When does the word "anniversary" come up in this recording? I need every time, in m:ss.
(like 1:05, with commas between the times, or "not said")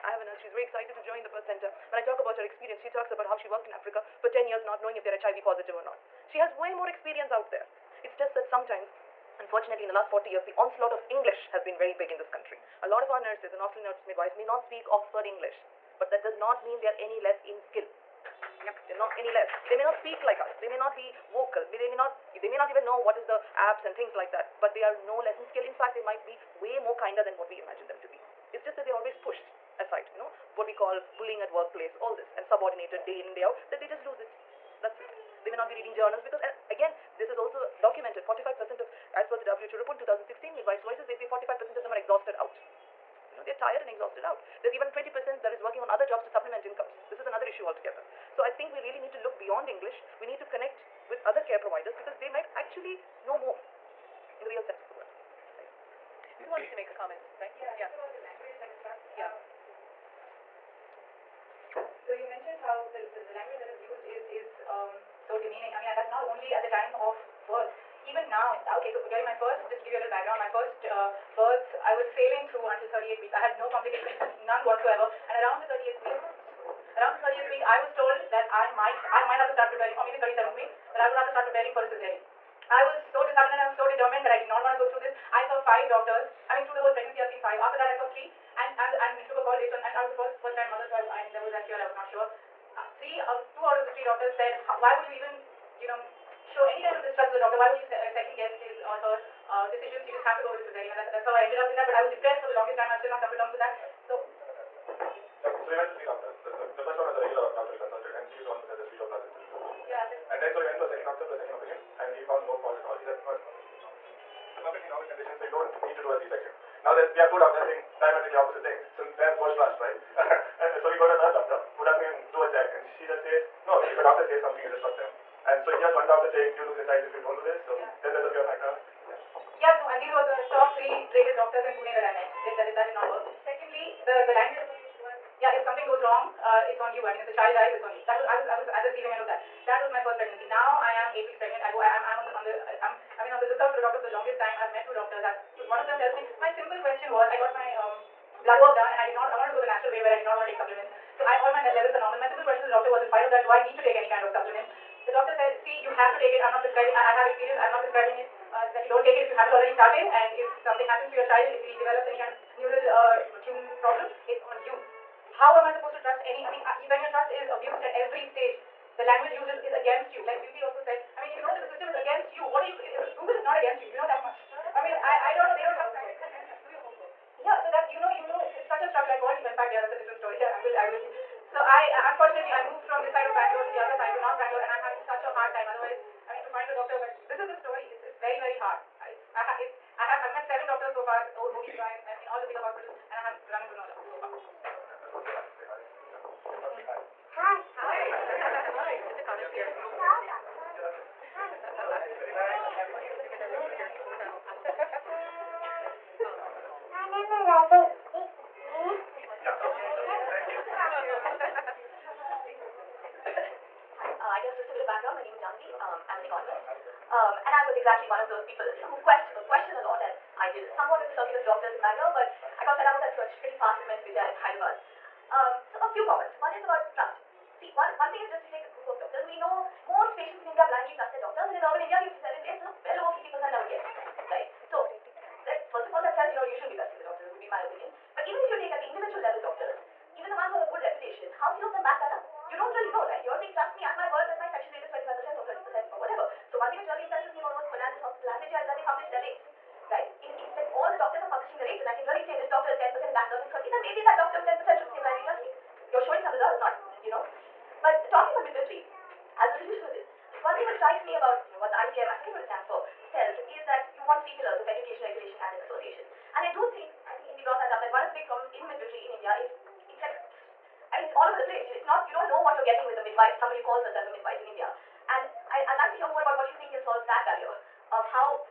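not said.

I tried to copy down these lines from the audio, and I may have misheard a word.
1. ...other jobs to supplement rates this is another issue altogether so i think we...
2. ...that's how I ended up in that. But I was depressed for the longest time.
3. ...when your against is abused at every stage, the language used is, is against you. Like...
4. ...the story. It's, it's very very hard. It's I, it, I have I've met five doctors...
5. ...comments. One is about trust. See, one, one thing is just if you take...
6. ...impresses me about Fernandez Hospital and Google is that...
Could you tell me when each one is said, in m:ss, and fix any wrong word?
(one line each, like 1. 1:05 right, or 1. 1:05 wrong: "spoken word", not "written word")
1. 0:45 wrong: "incomes", not "rates"
2. 1:41 right
3. 2:46 wrong: "trust", not "against"
4. 3:07 wrong: "seven", not "five"
5. 3:46 right
6. 4:07 wrong: "Vijaya", not "Google".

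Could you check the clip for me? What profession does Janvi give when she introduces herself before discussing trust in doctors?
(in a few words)
Economist.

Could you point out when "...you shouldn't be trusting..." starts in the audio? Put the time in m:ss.
3:56.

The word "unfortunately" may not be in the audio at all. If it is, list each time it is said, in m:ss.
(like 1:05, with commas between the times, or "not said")
0:09, 3:02.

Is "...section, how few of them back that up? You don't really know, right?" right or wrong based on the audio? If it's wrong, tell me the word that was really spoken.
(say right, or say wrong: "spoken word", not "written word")
wrong: "reputation", not "section".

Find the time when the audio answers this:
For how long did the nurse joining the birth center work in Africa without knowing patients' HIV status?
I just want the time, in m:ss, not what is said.
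0:04.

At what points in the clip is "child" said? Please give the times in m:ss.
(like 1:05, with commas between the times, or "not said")
2:06, 2:17, 2:41.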